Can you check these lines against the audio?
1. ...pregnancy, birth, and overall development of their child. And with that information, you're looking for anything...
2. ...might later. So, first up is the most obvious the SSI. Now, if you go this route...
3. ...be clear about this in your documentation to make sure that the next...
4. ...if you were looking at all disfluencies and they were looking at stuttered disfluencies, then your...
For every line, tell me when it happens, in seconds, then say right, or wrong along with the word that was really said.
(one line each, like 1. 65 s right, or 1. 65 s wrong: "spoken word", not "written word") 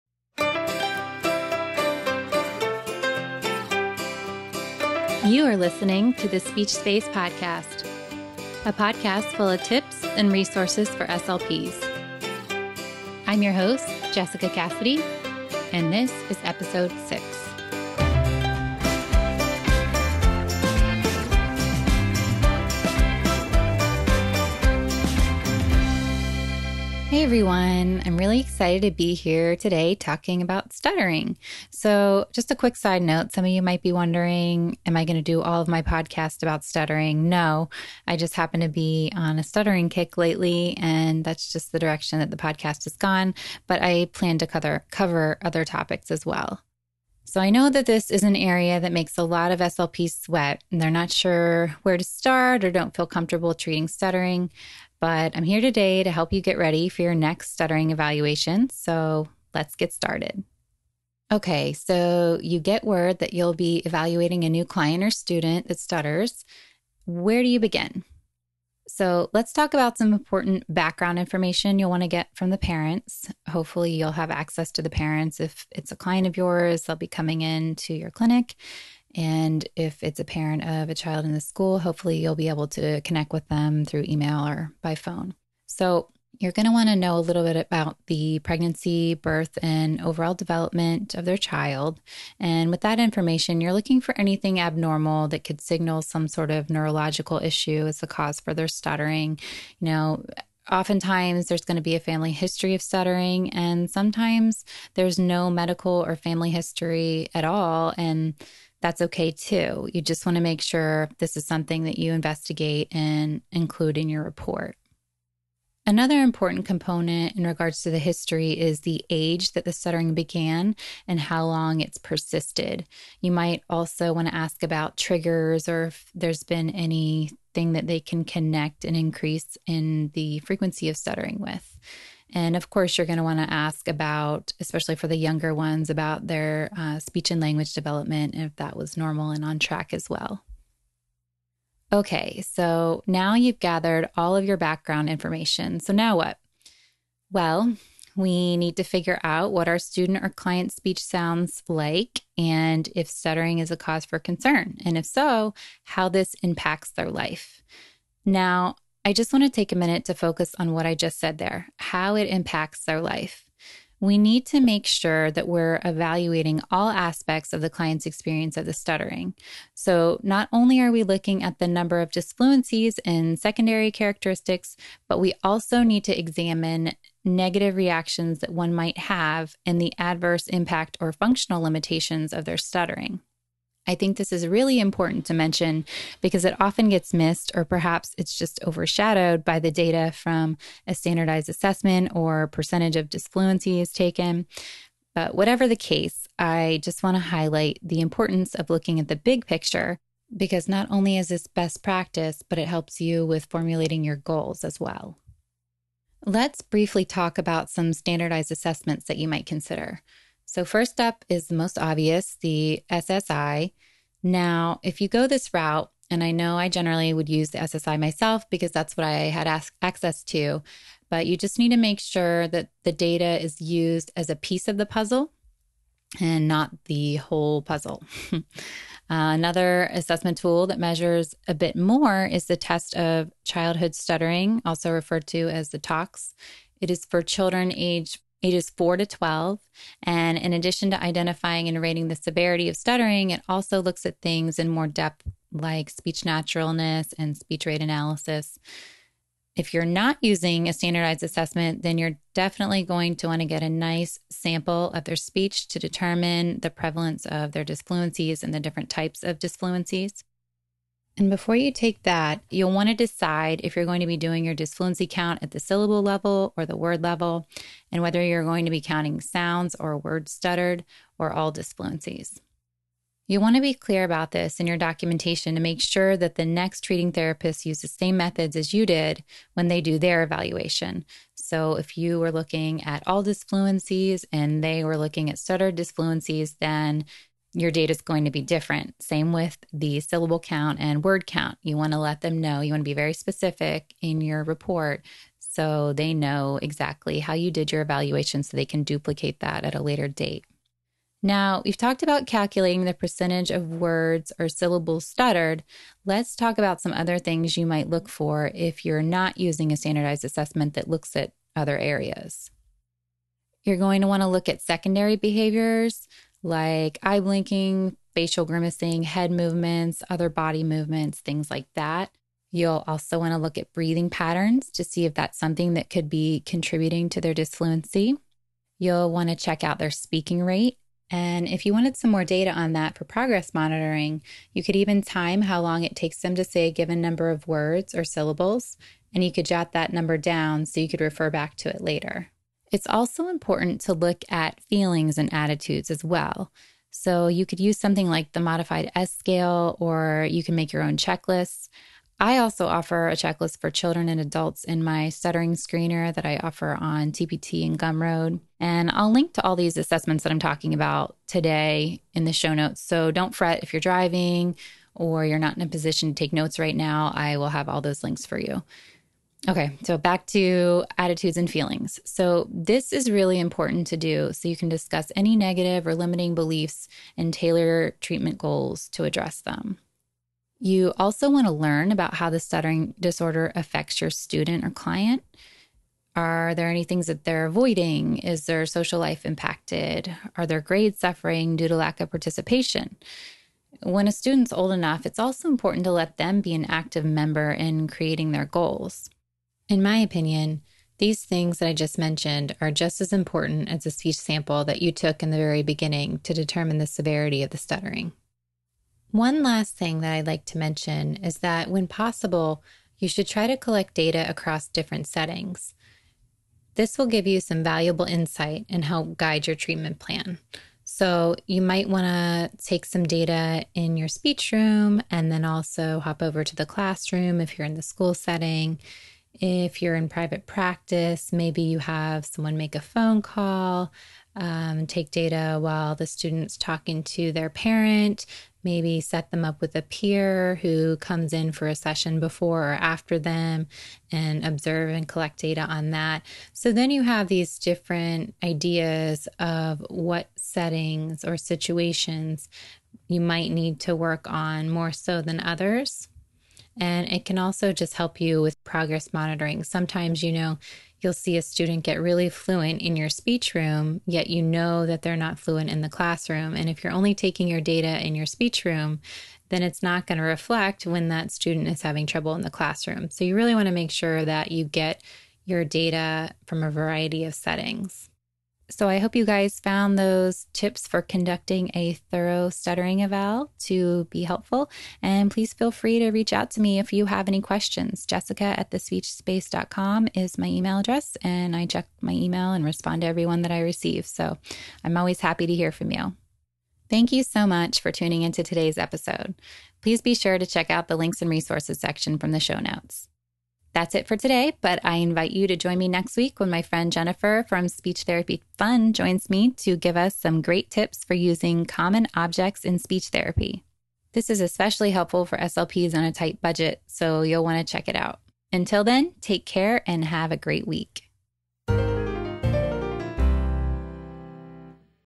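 1. 88 s right
2. 209 s wrong: "consider", not "later"
3. 273 s right
4. 281 s right.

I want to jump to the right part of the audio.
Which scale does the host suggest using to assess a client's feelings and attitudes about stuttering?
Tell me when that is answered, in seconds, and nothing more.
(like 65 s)
348 s.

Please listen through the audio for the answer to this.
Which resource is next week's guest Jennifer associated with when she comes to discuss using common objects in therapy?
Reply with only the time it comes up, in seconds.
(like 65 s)
507 s.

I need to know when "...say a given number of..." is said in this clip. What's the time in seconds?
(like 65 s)
336 s.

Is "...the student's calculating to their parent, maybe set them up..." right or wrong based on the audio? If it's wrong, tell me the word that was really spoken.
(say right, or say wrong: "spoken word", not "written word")
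wrong: "talking", not "calculating".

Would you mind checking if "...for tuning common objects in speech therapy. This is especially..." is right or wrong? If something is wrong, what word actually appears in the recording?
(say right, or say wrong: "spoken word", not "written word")
wrong: "using", not "tuning".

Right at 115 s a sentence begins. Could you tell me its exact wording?
Another important component in regards to the history is the age that the stuttering began and how long it's persisted.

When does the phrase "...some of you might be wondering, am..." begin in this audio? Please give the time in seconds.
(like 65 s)
33 s.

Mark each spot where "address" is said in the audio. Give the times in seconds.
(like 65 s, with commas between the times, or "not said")
379 s, 490 s.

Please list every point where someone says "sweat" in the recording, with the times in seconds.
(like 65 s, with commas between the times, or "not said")
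50 s.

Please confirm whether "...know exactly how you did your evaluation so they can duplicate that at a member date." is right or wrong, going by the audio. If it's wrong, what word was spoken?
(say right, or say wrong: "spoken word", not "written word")
wrong: "later", not "member".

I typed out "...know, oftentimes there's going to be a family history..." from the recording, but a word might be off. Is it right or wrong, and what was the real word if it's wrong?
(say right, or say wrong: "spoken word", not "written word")
right.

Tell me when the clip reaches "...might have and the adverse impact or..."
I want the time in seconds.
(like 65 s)
178 s.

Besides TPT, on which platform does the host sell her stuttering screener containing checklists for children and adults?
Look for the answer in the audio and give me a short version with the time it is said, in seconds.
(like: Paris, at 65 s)
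Gumroad, at 357 s.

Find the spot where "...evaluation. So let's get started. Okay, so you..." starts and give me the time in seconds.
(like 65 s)
57 s.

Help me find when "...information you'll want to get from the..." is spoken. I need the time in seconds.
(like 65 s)
71 s.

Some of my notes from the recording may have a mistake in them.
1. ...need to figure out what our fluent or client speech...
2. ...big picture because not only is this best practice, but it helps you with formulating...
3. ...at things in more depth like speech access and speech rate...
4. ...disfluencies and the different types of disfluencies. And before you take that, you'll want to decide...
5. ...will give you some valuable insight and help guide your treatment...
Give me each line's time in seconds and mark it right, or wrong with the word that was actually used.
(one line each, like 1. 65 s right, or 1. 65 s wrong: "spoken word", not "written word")
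1. 148 s wrong: "student", not "fluent"
2. 199 s right
3. 244 s wrong: "naturalness", not "access"
4. 257 s right
5. 416 s right.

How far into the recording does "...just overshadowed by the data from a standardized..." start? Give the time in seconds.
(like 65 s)
188 s.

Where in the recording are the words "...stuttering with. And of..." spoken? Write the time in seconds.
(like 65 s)
130 s.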